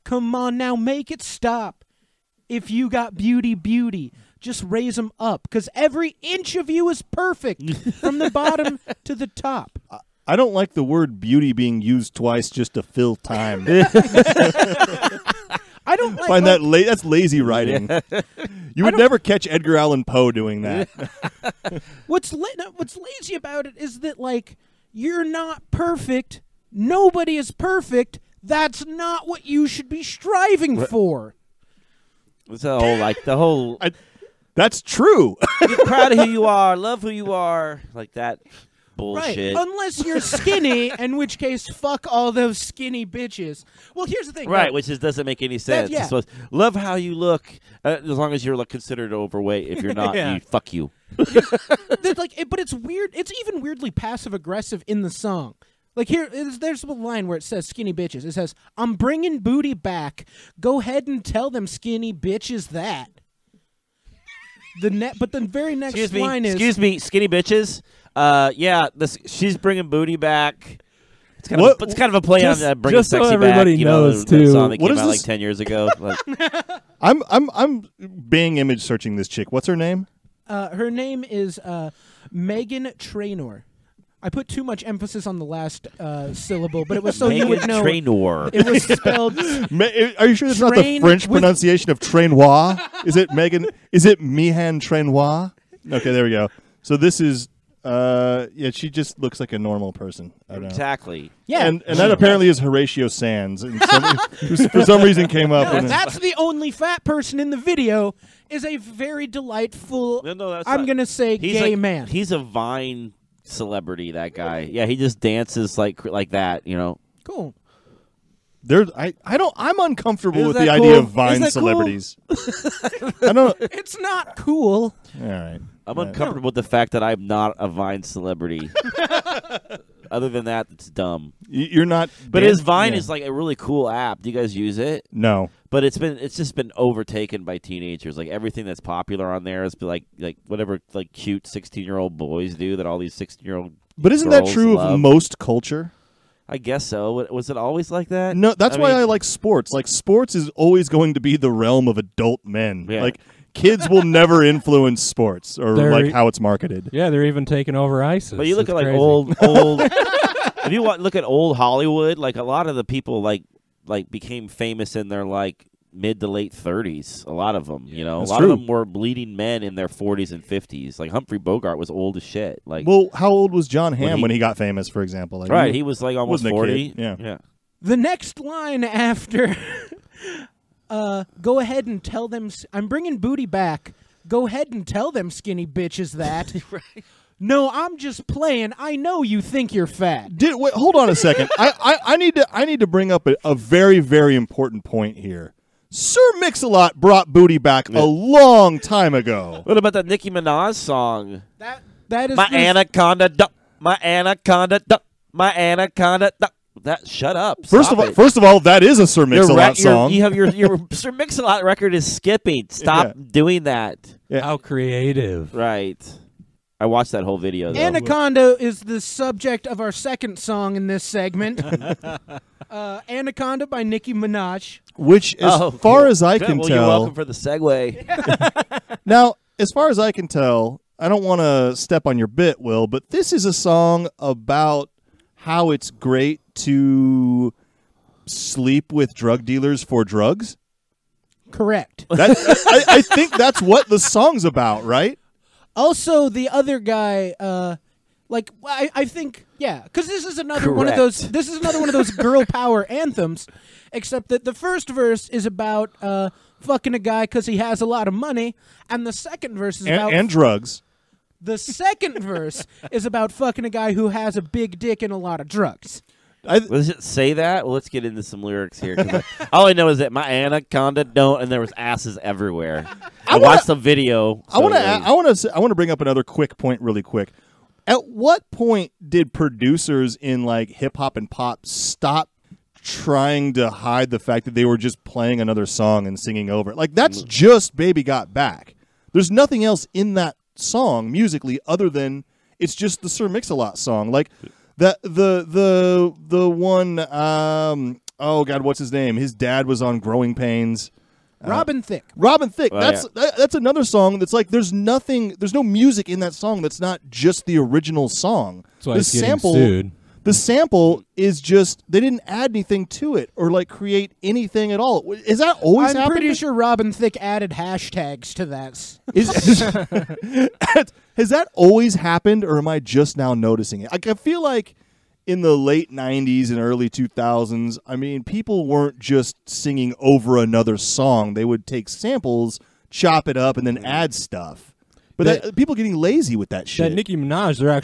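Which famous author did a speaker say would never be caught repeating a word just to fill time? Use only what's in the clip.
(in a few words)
Edgar Allan Poe.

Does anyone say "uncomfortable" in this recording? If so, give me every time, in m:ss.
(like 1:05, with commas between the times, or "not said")
1:59, 2:05.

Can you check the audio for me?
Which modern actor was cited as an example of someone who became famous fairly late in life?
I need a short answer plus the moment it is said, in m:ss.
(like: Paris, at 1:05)
Jon Hamm, at 2:53.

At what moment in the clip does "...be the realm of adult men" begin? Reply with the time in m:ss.
2:31.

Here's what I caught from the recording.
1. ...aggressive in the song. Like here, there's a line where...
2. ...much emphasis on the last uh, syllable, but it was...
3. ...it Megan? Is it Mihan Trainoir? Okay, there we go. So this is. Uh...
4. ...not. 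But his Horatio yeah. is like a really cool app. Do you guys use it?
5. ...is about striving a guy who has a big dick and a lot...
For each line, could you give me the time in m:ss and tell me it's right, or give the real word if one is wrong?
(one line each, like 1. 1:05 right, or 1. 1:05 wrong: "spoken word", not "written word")
1. 0:54 right
2. 1:24 right
3. 1:33 right
4. 2:11 wrong: "Vine", not "Horatio"
5. 4:22 wrong: "fucking", not "striving".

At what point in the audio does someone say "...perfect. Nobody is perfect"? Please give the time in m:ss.
0:25.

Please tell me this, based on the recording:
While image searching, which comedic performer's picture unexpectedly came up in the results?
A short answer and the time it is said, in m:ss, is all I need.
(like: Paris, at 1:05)
Horatio Sanz, at 1:42.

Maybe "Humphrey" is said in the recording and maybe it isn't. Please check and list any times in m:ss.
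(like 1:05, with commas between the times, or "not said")
2:51.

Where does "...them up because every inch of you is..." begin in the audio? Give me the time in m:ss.
0:04.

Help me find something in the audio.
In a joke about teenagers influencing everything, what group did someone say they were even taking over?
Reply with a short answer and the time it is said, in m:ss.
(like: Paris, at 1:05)
ISIS, at 2:38.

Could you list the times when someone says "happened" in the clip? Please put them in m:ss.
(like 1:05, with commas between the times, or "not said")
5:21.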